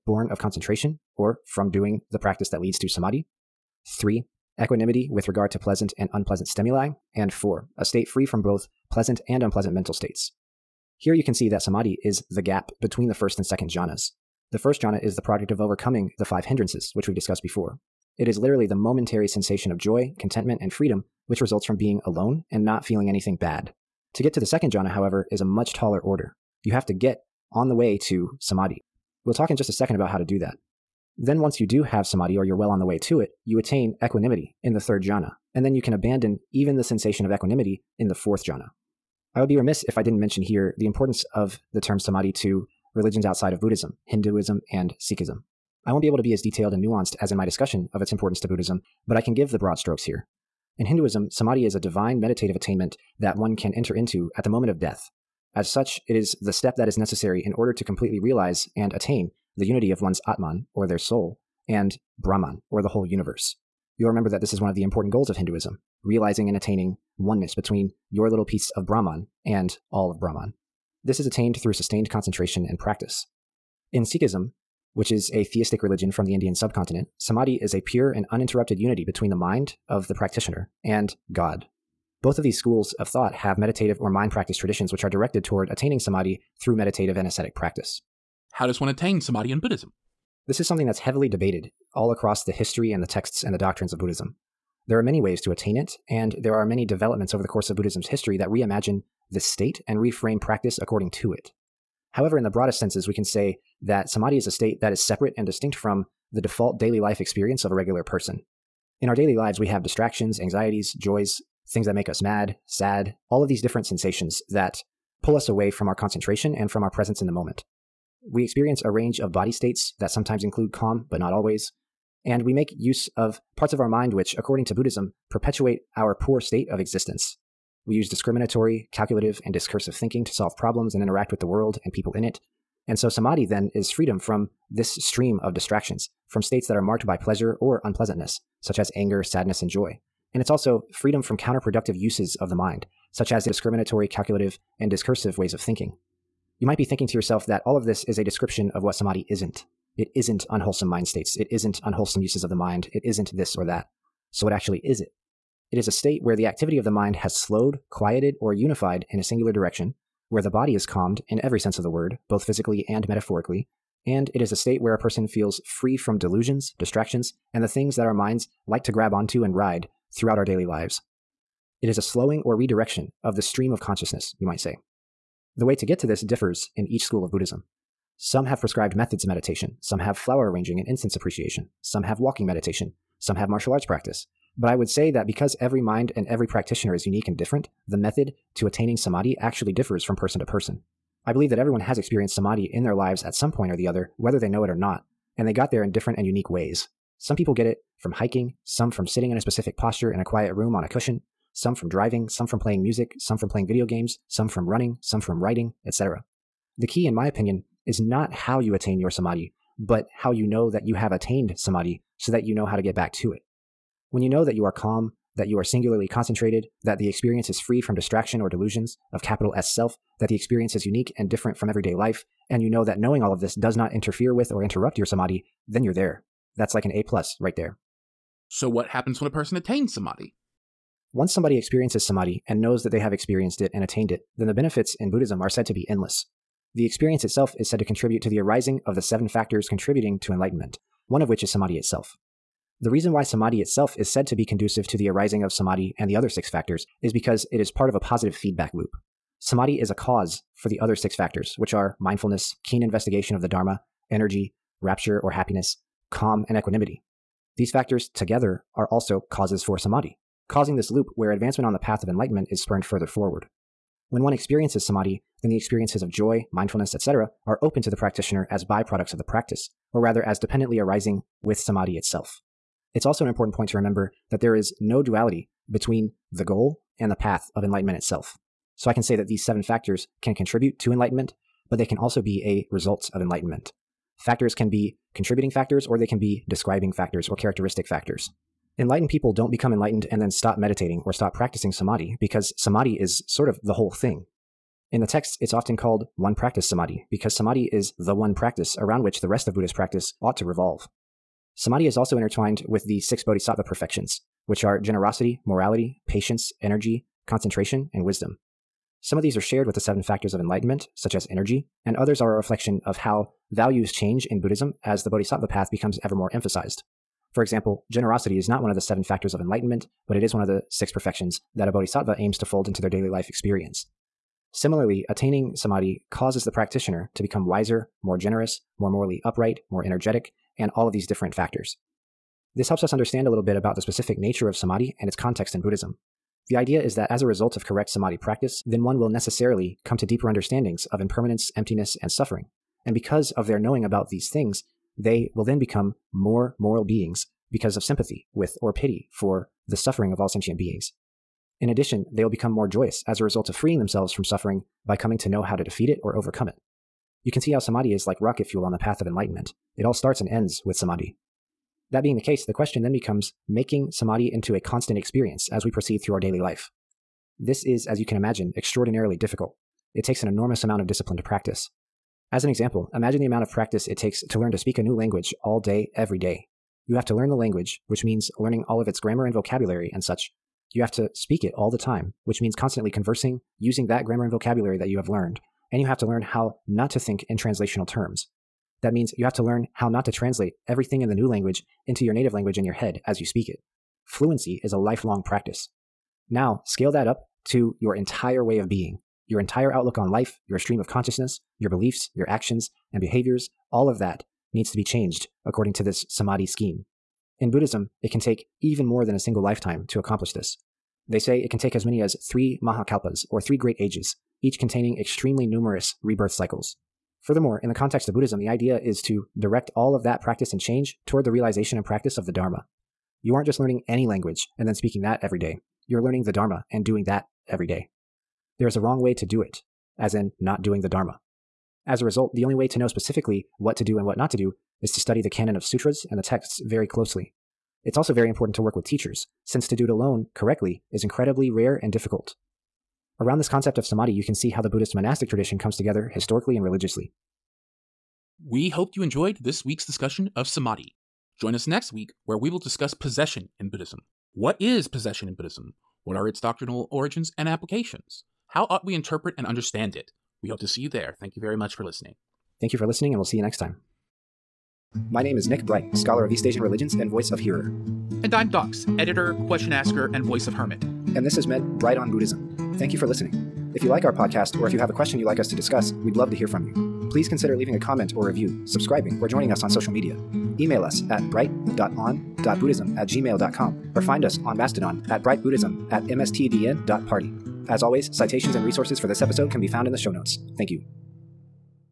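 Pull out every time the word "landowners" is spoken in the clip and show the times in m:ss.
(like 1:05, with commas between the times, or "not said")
not said.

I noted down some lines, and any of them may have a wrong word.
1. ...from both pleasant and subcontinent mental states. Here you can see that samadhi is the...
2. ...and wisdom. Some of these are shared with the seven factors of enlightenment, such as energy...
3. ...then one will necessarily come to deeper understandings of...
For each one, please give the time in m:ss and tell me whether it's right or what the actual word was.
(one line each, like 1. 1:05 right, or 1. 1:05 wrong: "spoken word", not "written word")
1. 0:08 wrong: "unpleasant", not "subcontinent"
2. 5:07 right
3. 5:38 right.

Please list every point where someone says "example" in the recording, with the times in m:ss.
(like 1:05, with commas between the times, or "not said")
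5:17, 6:12.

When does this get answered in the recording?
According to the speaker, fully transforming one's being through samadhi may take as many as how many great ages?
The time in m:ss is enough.
6:52.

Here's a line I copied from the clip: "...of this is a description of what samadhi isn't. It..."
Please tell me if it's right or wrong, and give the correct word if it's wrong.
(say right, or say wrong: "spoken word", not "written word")
right.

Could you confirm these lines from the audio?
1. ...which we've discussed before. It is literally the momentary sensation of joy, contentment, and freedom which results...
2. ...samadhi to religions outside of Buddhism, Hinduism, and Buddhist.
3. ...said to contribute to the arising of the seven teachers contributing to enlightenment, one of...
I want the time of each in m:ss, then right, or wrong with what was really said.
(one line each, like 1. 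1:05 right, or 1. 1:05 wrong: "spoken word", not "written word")
1. 0:16 right
2. 0:41 wrong: "Sikhism", not "Buddhist"
3. 3:57 wrong: "factors", not "teachers".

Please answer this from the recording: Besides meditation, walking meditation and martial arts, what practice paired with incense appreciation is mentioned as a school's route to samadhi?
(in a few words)
Flower arranging.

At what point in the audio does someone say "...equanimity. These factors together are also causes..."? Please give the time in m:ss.
4:16.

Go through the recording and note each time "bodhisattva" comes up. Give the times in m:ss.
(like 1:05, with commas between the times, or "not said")
5:03, 5:15, 5:21.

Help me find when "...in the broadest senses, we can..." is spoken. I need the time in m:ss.
1:42.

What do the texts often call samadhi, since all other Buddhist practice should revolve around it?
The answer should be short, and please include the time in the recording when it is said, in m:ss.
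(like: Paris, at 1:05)
One practice samadhi, at 4:56.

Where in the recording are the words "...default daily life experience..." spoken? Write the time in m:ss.
1:46.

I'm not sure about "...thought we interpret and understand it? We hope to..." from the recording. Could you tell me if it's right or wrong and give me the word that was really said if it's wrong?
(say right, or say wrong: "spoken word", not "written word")
wrong: "ought", not "thought".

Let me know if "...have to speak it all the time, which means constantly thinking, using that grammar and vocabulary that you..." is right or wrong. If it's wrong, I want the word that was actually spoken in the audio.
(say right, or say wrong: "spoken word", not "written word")
wrong: "conversing", not "thinking".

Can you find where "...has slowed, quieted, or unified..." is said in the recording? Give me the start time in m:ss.
2:37.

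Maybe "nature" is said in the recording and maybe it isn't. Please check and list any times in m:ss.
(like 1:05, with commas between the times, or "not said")
5:34.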